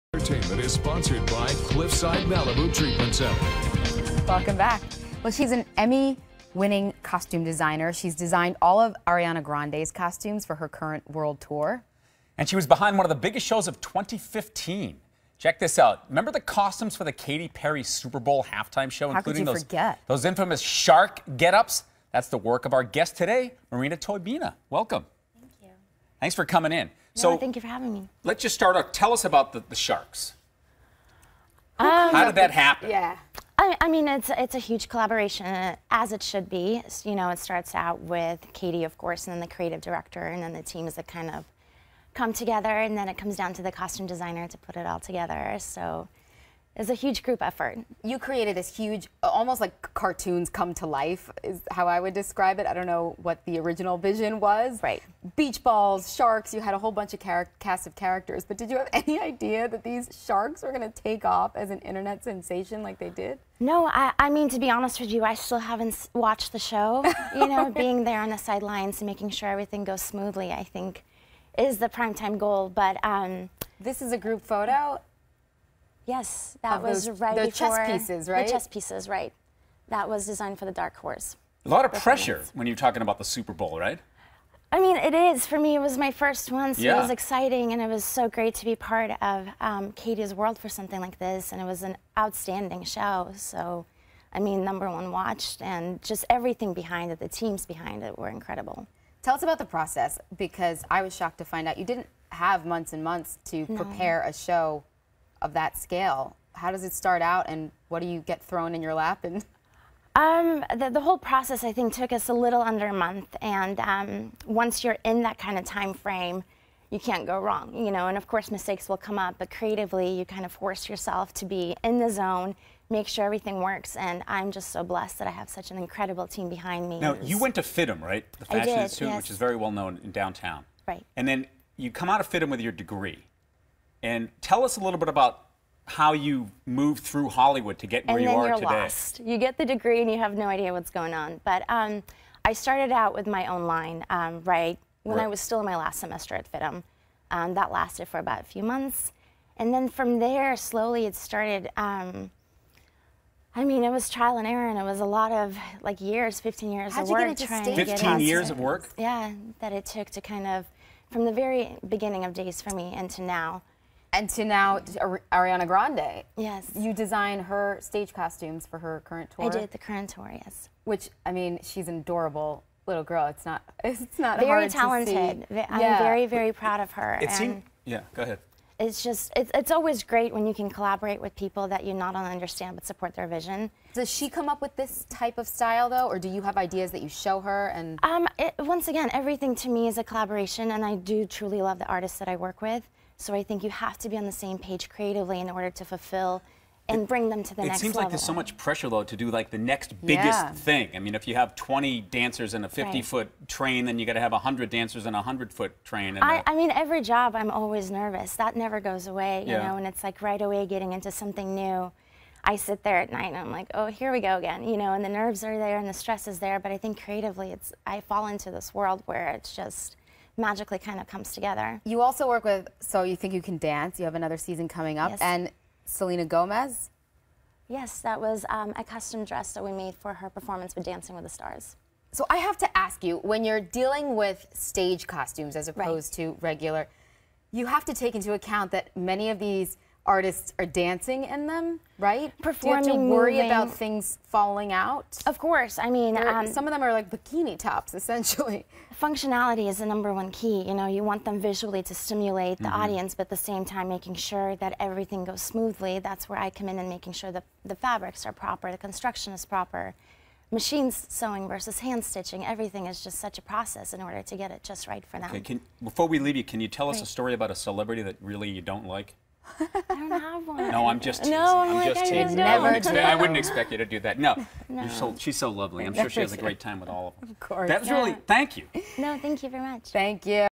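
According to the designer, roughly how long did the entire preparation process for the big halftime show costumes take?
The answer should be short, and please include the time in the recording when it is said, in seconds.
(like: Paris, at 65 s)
a little under a month, at 112 s.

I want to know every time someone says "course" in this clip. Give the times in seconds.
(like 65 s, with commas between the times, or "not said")
38 s, 118 s, 245 s, 277 s.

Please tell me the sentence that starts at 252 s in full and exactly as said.
audience, but at the same time, making sure that everything goes smoothly.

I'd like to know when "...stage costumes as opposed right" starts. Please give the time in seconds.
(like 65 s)
234 s.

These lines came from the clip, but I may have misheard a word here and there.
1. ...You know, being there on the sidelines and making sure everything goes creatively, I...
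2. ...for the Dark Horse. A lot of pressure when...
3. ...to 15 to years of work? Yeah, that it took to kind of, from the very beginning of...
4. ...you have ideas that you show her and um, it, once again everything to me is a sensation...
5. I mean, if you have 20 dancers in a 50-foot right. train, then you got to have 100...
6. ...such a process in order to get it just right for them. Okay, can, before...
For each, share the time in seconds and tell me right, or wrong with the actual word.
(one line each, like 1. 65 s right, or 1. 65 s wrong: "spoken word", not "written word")
1. 67 s wrong: "smoothly", not "creatively"
2. 80 s right
3. 157 s right
4. 186 s wrong: "collaboration", not "sensation"
5. 200 s right
6. 263 s right.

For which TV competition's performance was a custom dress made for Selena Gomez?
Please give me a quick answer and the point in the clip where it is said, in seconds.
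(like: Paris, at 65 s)
Dancing with the Stars, at 230 s.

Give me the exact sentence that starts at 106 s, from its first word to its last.
How does it start out, and what do you get thrown in your lap?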